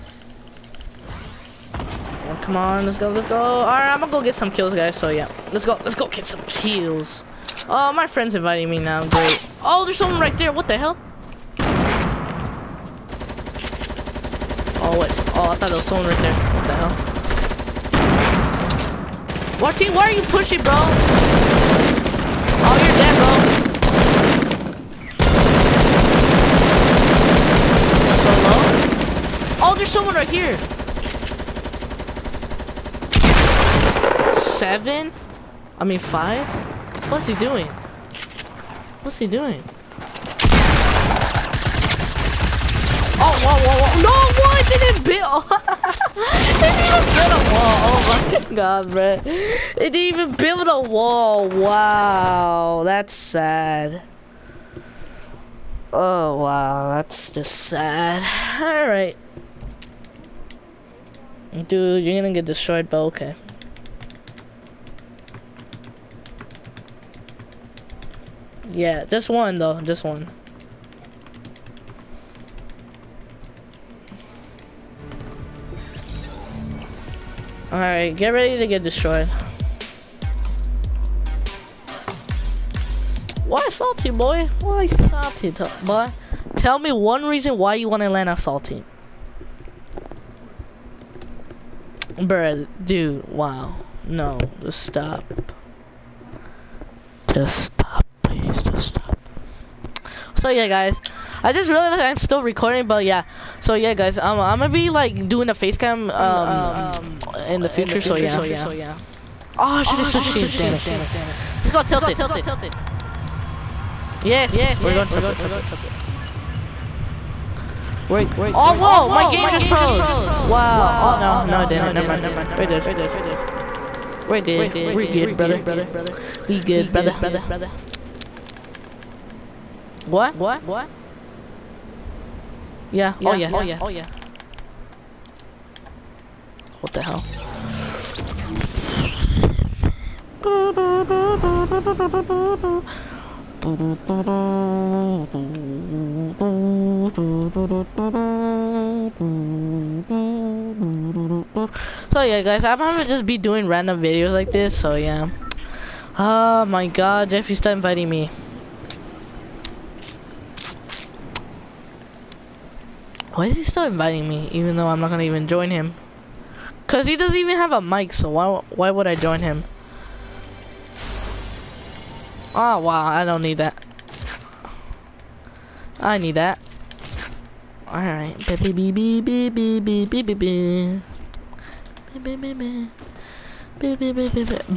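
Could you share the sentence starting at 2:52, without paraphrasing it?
Oh, wow, I don't need that.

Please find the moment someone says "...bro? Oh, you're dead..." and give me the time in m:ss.
0:20.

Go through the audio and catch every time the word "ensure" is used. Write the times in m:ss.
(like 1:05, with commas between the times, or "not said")
not said.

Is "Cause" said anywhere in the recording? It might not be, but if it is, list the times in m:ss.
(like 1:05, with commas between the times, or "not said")
2:46.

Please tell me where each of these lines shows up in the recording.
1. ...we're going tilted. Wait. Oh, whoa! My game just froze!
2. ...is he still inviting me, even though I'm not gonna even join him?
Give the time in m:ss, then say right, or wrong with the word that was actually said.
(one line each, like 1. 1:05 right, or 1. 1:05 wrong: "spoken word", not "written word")
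1. 1:54 right
2. 2:43 right.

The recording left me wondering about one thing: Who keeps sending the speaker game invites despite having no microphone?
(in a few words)
Jeffy.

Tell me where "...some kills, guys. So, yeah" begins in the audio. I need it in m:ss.
0:04.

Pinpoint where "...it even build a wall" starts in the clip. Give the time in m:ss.
0:45.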